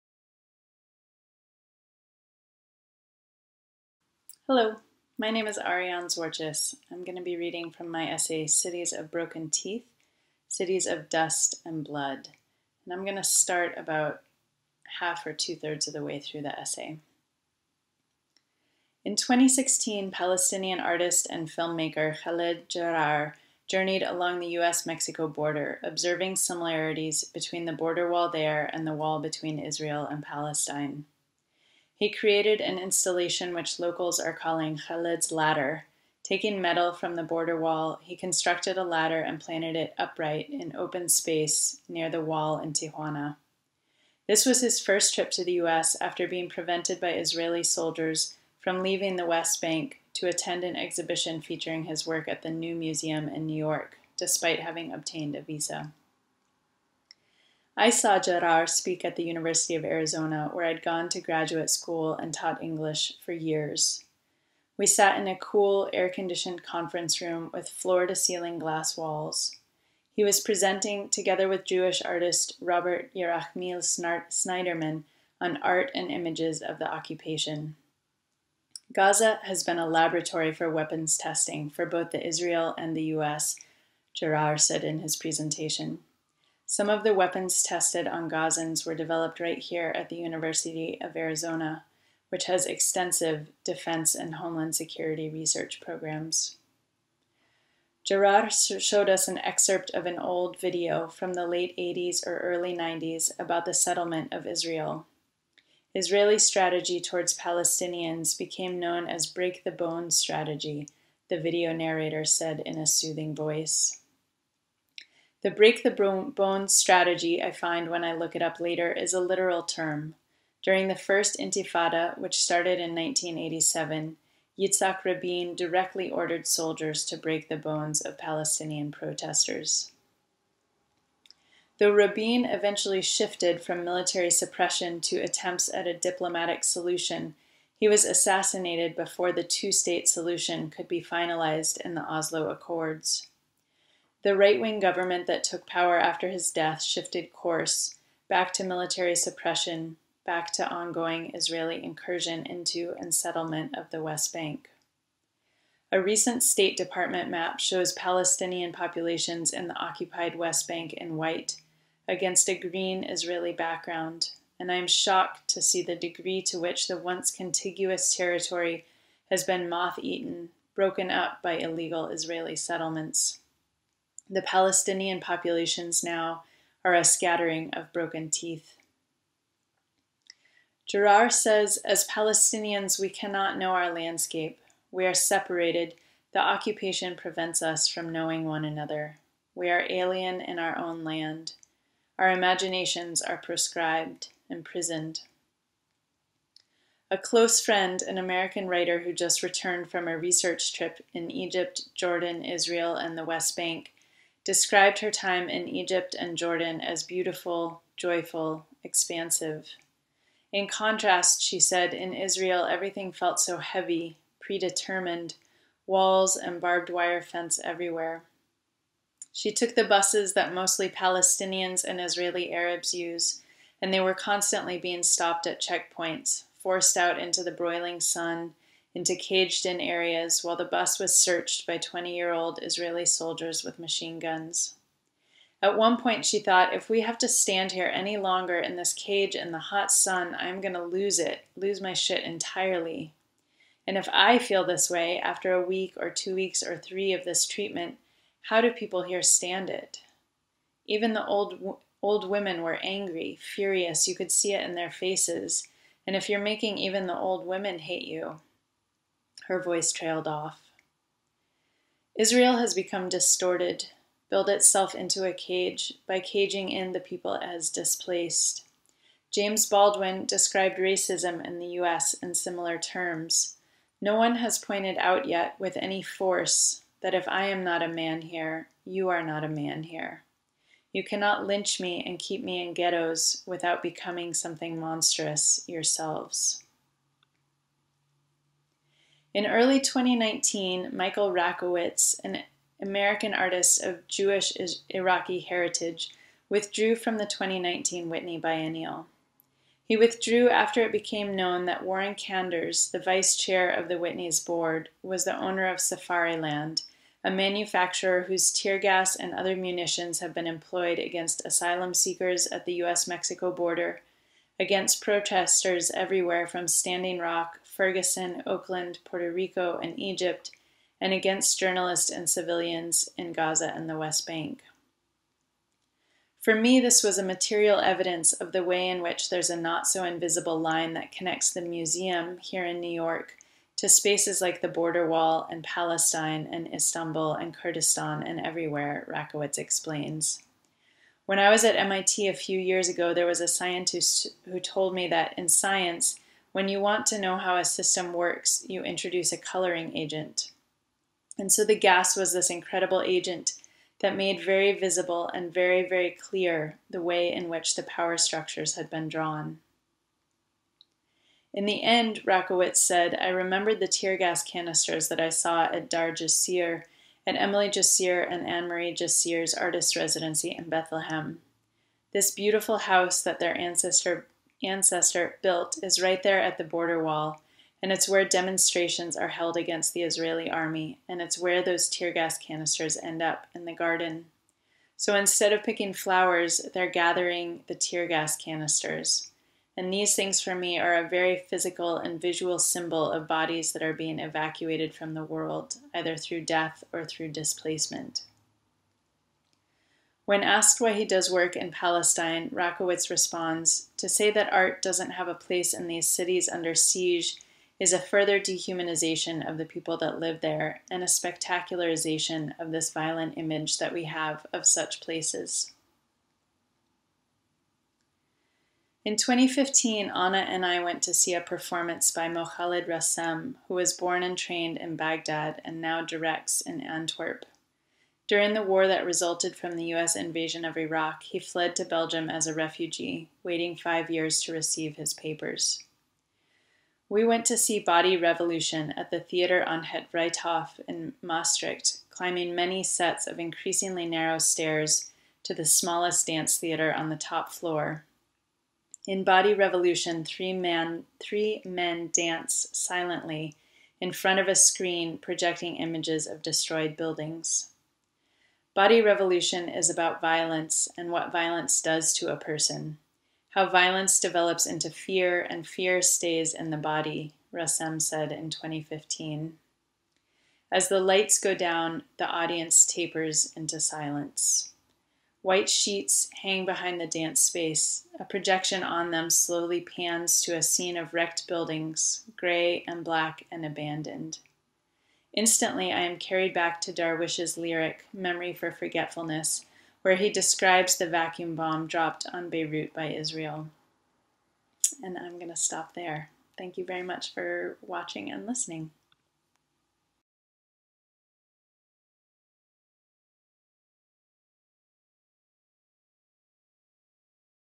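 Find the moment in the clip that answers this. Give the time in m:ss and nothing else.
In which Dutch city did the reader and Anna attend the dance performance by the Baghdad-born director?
7:21.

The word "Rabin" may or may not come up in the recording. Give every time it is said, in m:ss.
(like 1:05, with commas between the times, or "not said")
2:05, 2:11.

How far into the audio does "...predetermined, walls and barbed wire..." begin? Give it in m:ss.
3:34.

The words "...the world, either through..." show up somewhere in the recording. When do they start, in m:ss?
6:35.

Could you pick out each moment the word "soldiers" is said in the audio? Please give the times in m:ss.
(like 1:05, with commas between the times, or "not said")
0:47, 2:06, 3:53.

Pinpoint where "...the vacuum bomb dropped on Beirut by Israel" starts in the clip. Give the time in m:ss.
8:10.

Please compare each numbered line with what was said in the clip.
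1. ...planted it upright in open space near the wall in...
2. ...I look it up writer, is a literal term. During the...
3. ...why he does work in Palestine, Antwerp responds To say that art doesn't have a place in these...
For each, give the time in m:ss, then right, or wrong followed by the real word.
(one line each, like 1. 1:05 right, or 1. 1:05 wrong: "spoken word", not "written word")
1. 0:39 right
2. 1:58 wrong: "later", not "writer"
3. 6:40 wrong: "Rakowitz", not "Antwerp".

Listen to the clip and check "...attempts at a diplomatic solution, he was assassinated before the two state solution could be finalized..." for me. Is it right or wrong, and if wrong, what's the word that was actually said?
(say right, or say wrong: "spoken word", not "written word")
right.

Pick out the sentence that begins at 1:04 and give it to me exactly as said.
We sat in a cool, air conditioned conference room with floor to ceiling glass walls.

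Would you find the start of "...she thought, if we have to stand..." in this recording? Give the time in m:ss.
3:56.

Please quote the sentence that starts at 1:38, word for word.
Jarrar showed us an excerpt of an old video from the late 80s or early 90s about the settlement of Israel.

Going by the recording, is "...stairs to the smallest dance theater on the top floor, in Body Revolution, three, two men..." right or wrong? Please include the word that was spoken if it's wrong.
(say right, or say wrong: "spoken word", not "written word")
wrong: "three", not "two".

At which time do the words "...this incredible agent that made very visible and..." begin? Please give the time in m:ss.
5:52.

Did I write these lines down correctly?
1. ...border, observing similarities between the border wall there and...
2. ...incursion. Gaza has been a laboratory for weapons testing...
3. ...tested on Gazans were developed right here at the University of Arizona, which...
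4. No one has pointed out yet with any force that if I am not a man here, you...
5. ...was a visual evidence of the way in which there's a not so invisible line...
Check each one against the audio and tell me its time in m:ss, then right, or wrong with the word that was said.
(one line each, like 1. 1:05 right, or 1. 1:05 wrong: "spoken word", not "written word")
1. 0:25 right
2. 1:16 wrong: "occupation", not "incursion"
3. 1:27 right
4. 4:33 right
5. 5:27 wrong: "material", not "visual".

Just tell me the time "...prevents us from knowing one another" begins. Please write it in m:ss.
3:07.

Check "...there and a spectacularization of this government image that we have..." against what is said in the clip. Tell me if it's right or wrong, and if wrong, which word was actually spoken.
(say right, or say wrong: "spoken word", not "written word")
wrong: "violent", not "government".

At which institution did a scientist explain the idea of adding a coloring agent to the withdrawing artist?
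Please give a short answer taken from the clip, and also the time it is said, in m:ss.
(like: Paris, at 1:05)
MIT, at 5:41.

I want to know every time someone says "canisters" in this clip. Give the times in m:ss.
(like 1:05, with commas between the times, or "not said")
6:04, 6:22, 6:28.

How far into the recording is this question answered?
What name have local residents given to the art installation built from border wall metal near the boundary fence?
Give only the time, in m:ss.
0:34.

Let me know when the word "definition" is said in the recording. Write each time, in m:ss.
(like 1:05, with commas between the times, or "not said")
not said.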